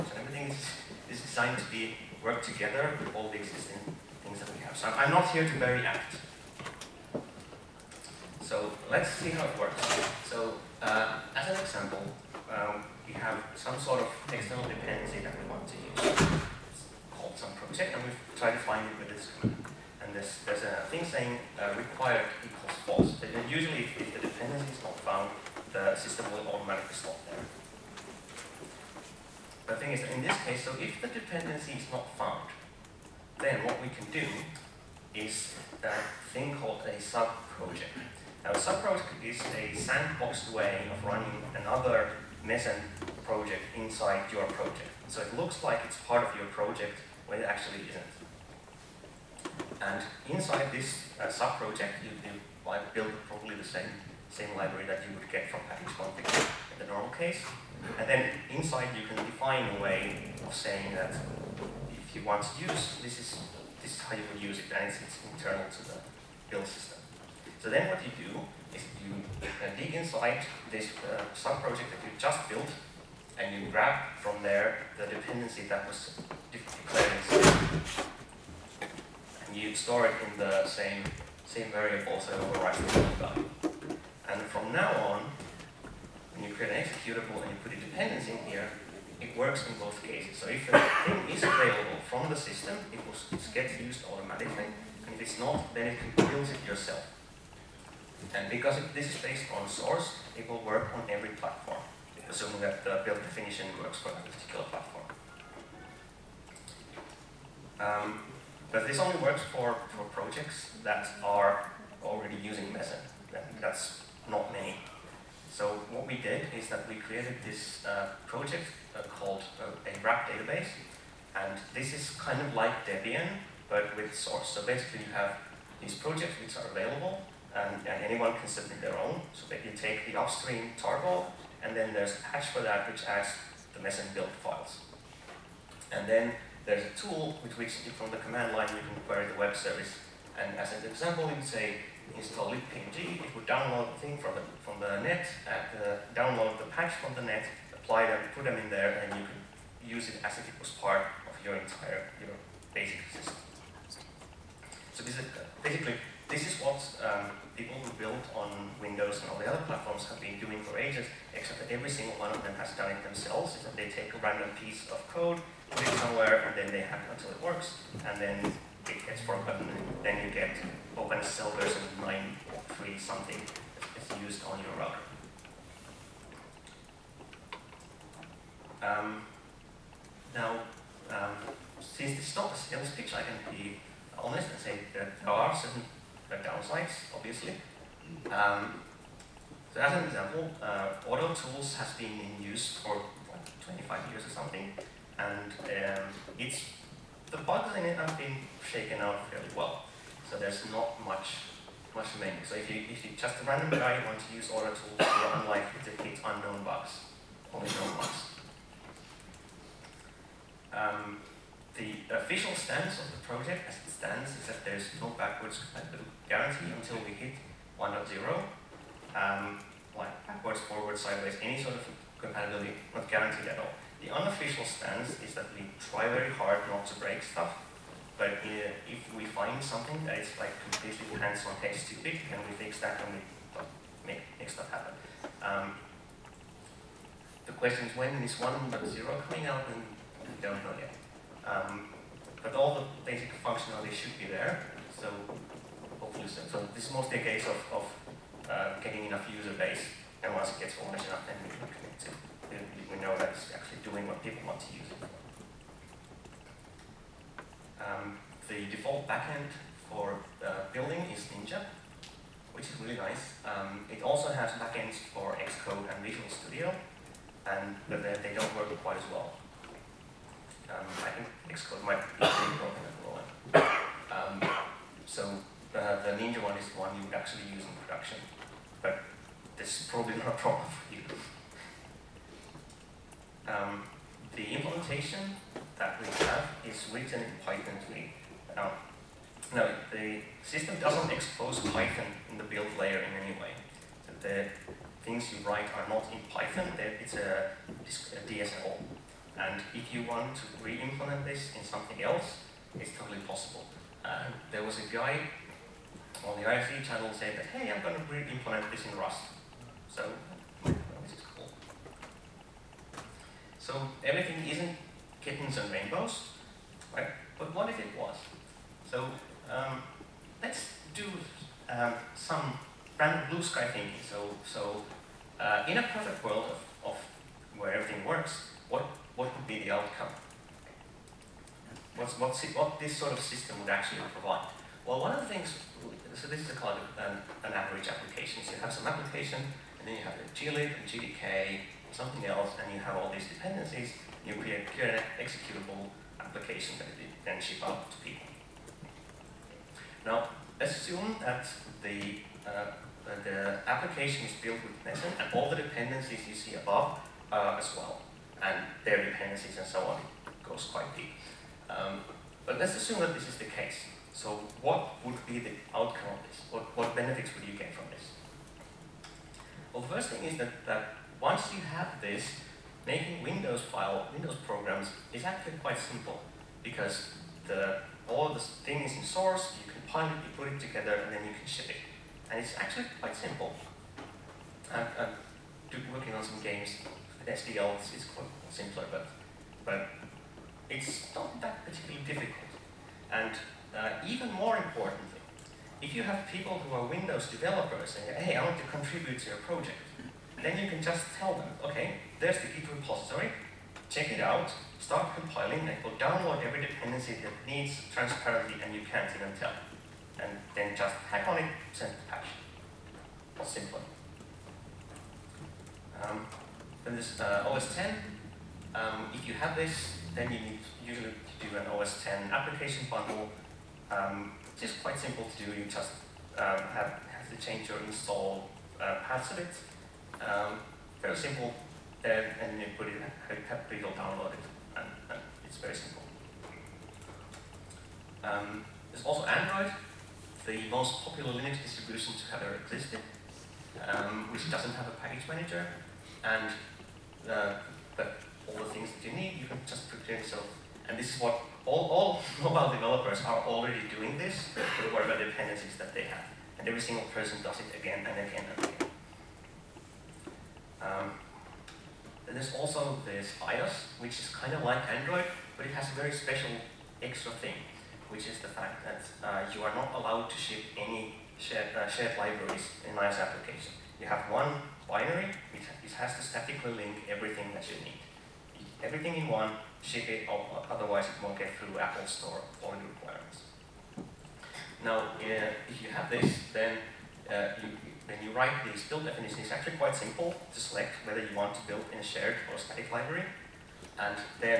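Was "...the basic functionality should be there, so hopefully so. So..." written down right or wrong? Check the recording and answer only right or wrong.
right.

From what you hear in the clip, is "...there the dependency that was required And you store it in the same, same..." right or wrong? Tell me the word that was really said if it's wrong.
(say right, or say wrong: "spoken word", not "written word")
wrong: "declared", not "required".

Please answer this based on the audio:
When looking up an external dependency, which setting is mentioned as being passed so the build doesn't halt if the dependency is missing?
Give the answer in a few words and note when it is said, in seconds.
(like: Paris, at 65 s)
required equals false, at 21 s.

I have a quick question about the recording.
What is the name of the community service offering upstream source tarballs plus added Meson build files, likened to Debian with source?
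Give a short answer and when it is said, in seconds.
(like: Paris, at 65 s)
wrap database, at 120 s.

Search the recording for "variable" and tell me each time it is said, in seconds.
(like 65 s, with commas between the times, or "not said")
81 s.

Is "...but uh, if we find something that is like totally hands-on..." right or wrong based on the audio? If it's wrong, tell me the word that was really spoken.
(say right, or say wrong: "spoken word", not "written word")
wrong: "completely", not "totally".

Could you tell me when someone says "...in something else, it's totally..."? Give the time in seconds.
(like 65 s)
301 s.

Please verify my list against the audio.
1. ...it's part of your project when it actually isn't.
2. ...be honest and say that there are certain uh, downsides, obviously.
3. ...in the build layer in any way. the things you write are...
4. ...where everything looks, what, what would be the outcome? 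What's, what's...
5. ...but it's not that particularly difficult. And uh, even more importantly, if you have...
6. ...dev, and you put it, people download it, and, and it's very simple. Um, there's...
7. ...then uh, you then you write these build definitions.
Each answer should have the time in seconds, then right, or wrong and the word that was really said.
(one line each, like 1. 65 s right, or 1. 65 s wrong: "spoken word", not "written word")
1. 45 s right
2. 183 s right
3. 292 s right
4. 327 s wrong: "works", not "looks"
5. 389 s right
6. 432 s right
7. 486 s right.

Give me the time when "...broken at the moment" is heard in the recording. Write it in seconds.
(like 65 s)
272 s.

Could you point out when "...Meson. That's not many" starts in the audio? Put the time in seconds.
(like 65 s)
112 s.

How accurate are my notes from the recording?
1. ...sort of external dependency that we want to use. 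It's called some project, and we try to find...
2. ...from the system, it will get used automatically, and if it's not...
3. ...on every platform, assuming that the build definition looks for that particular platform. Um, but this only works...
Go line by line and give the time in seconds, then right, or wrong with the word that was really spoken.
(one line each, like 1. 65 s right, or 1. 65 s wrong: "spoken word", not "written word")
1. 13 s right
2. 92 s right
3. 100 s wrong: "works", not "looks".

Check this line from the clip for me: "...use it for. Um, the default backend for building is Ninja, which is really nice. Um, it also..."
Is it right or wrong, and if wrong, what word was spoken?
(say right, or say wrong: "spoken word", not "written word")
right.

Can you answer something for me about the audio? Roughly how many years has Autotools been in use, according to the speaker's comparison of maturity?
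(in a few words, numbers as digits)
25.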